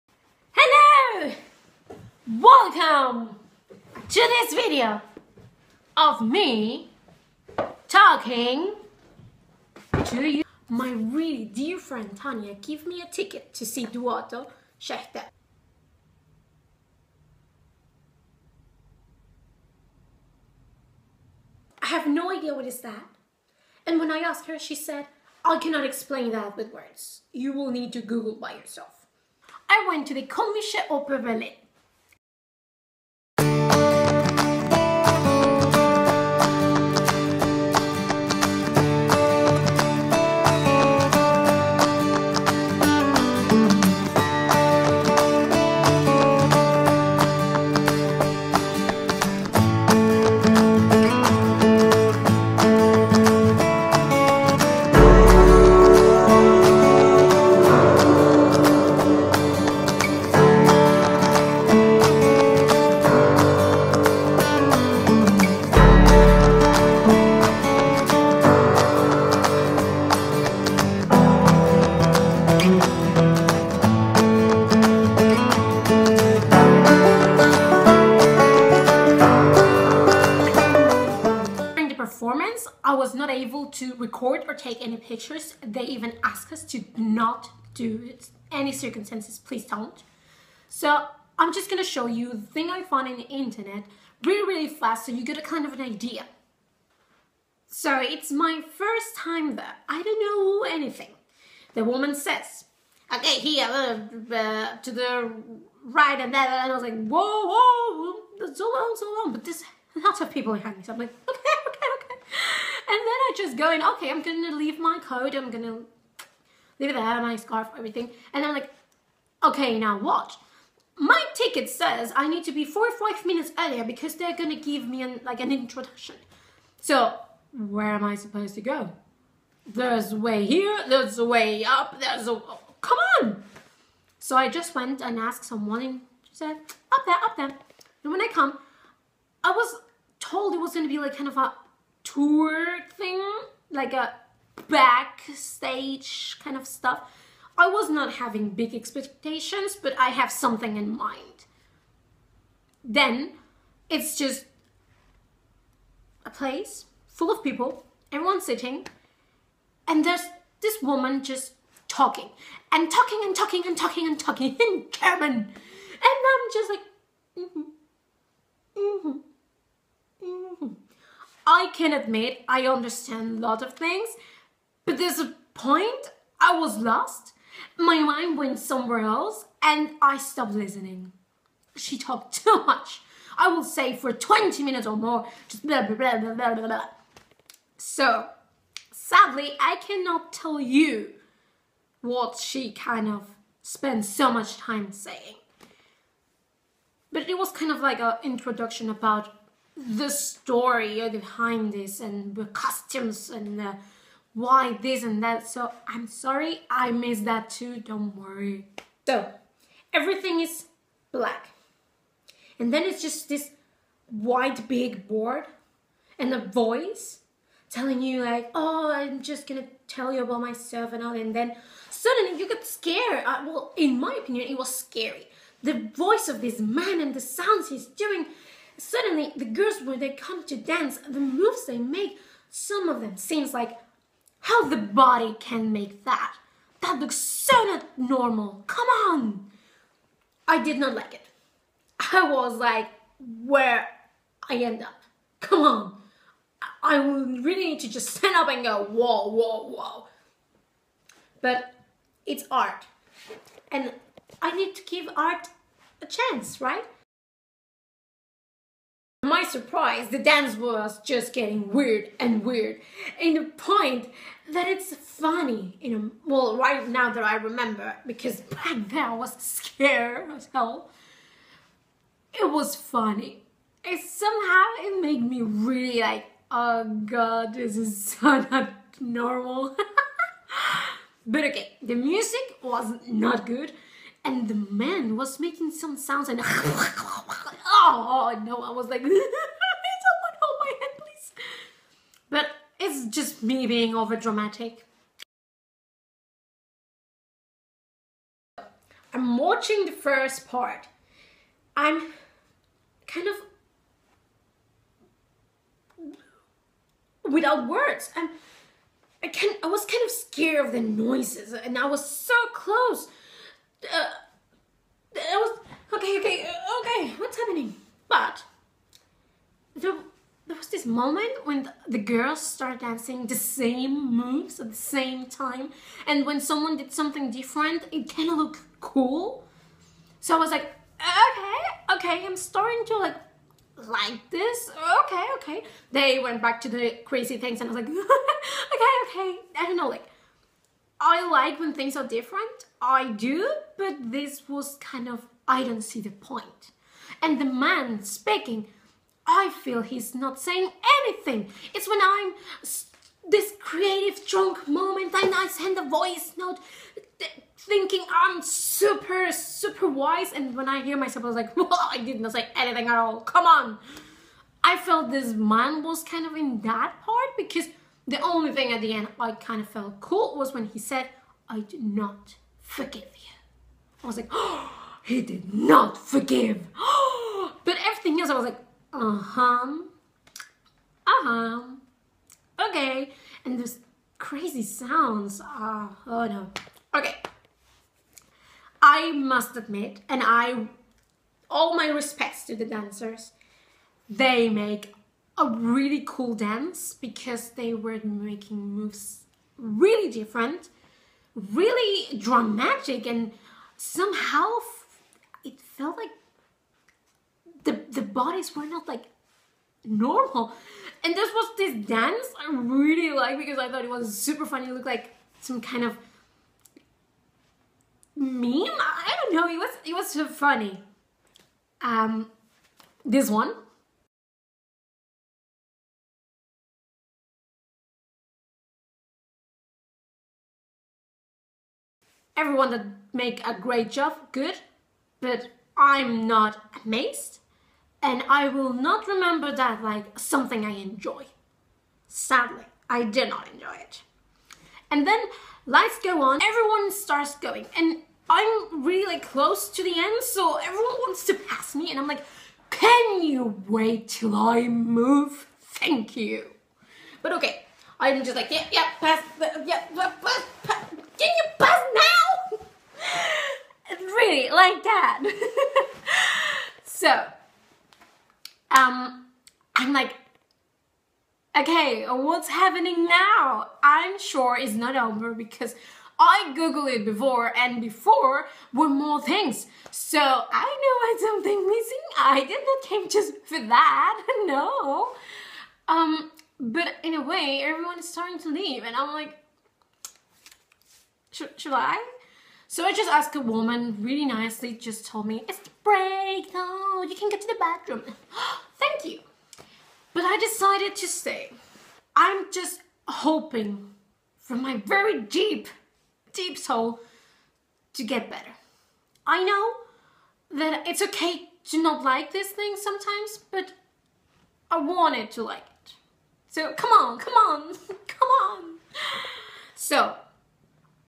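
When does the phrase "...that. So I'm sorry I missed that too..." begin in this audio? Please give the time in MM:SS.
03:25.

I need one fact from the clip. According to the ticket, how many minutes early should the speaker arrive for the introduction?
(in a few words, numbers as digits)
4 or 5.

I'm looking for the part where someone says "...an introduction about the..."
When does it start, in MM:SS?
03:17.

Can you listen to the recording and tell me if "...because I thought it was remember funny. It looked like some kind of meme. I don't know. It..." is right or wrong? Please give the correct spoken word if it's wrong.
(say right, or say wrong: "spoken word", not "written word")
wrong: "super", not "remember".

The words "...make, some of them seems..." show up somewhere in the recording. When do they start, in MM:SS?
03:51.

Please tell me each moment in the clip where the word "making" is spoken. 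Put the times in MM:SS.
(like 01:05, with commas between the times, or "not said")
04:45, 06:38.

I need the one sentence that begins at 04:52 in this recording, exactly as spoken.
But it's just me being over dramatic.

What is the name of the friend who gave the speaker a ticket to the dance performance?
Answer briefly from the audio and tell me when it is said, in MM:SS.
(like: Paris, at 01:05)
Tanya, at 00:12.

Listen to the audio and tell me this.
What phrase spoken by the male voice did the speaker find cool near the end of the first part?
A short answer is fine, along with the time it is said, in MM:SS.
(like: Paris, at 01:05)
I do not forgive you, at 06:11.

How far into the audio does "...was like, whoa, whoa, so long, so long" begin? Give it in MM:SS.
01:46.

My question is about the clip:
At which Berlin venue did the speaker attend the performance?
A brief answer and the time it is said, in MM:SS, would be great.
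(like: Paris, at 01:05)
Komische Oper Berlin, at 00:30.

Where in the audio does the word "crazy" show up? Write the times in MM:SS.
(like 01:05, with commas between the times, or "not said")
05:37, 06:24.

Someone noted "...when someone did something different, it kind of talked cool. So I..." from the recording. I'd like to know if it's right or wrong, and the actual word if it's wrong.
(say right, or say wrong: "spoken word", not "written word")
wrong: "looked", not "talked".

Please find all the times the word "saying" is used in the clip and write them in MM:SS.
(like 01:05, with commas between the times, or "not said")
03:14, 05:50.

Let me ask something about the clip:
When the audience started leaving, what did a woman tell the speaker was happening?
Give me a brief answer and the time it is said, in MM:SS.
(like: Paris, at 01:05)
The break, at 08:15.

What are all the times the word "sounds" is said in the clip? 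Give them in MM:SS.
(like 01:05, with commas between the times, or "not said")
03:47, 04:45, 06:24.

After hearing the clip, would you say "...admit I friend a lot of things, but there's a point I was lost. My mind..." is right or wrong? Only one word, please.
wrong.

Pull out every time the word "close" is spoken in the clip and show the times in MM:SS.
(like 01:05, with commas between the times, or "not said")
05:12, 07:29.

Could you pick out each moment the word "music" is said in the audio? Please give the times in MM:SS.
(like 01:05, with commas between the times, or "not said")
04:41.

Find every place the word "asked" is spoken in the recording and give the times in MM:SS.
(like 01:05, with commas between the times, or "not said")
00:24, 01:26, 02:15, 08:13.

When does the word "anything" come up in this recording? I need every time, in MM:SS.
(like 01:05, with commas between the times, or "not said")
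01:40, 05:51, 06:02.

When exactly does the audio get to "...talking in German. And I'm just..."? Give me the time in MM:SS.
02:44.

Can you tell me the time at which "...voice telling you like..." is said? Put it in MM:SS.
03:36.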